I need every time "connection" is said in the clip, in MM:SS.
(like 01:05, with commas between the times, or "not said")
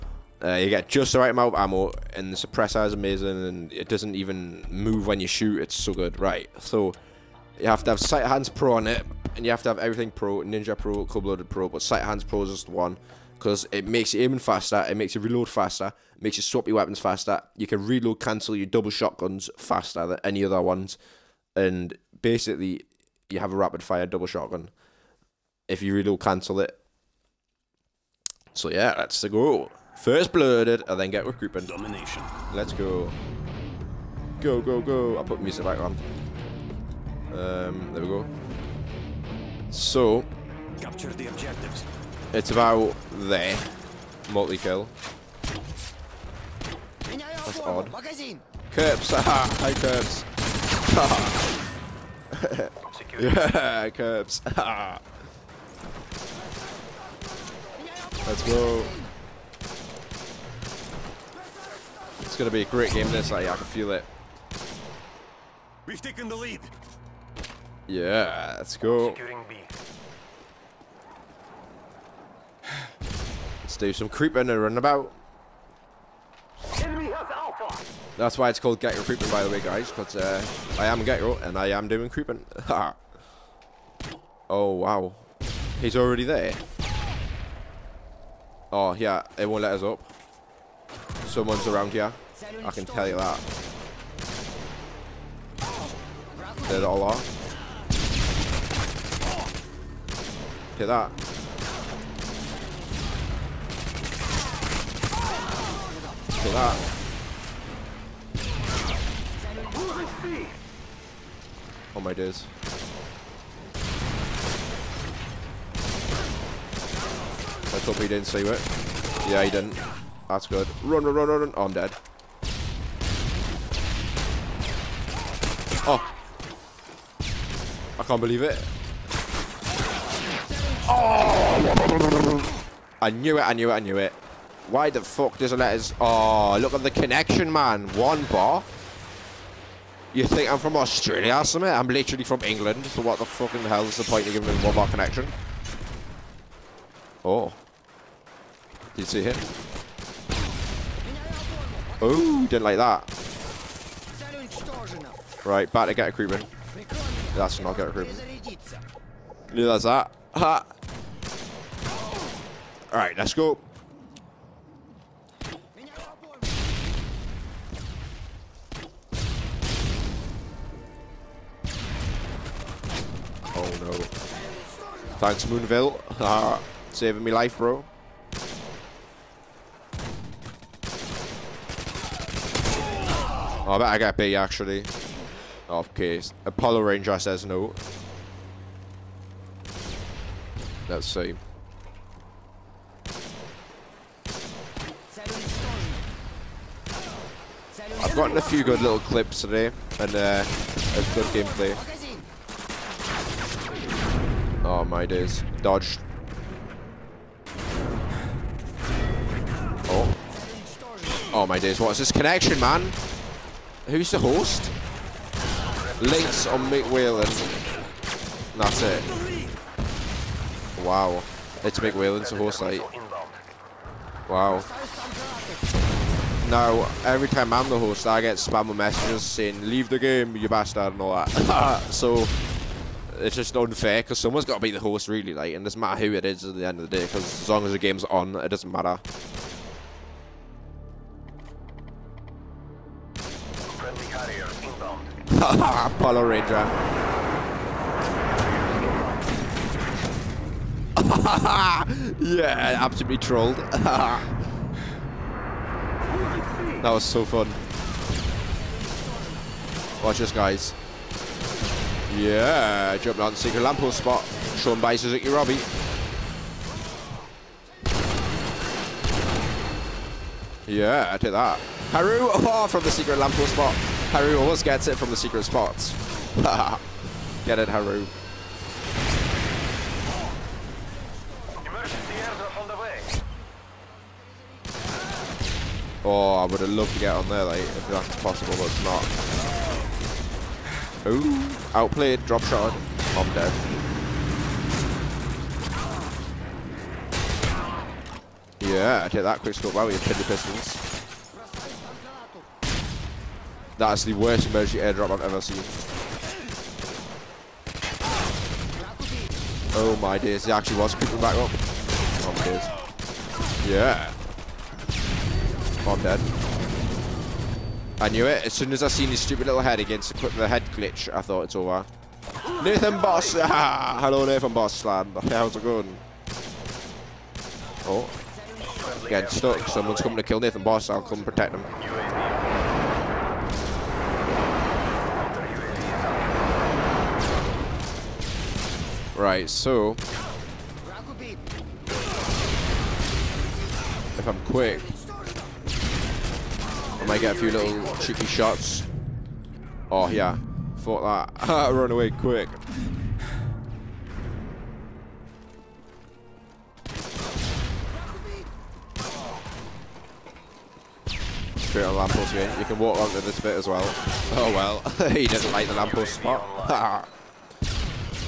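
02:16, 02:24, 03:32.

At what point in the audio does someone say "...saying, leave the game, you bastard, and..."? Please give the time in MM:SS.
03:49.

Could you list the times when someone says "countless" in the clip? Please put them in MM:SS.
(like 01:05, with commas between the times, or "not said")
not said.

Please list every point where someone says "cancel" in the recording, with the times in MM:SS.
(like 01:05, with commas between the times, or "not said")
00:18, 00:26.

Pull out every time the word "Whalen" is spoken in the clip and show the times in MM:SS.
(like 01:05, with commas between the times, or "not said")
03:36, 03:41.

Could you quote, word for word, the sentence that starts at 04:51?
Ooh, outplayed, drop shot, I'm dead.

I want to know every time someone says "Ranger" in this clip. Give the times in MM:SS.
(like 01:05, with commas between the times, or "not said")
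03:06, 04:06.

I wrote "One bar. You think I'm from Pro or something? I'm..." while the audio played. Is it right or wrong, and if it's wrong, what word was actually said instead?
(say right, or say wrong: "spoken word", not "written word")
wrong: "Australia", not "Pro".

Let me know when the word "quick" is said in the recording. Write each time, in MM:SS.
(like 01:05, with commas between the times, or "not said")
04:59, 05:44, 05:52.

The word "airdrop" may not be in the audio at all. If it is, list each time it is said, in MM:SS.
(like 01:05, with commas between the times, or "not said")
05:04.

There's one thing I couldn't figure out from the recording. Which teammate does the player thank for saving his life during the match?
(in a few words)
Moonville.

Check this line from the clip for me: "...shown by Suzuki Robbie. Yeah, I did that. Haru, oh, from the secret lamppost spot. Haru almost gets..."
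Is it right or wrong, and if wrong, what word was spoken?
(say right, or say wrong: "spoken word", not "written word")
right.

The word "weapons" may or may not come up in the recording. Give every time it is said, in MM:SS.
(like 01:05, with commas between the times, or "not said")
00:16.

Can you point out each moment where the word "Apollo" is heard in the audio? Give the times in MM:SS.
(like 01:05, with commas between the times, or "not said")
03:06, 04:05.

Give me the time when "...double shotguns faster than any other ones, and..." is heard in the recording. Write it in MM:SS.
00:18.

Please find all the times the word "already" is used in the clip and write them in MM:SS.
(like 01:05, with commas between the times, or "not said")
01:25.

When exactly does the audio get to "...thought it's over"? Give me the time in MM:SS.
05:21.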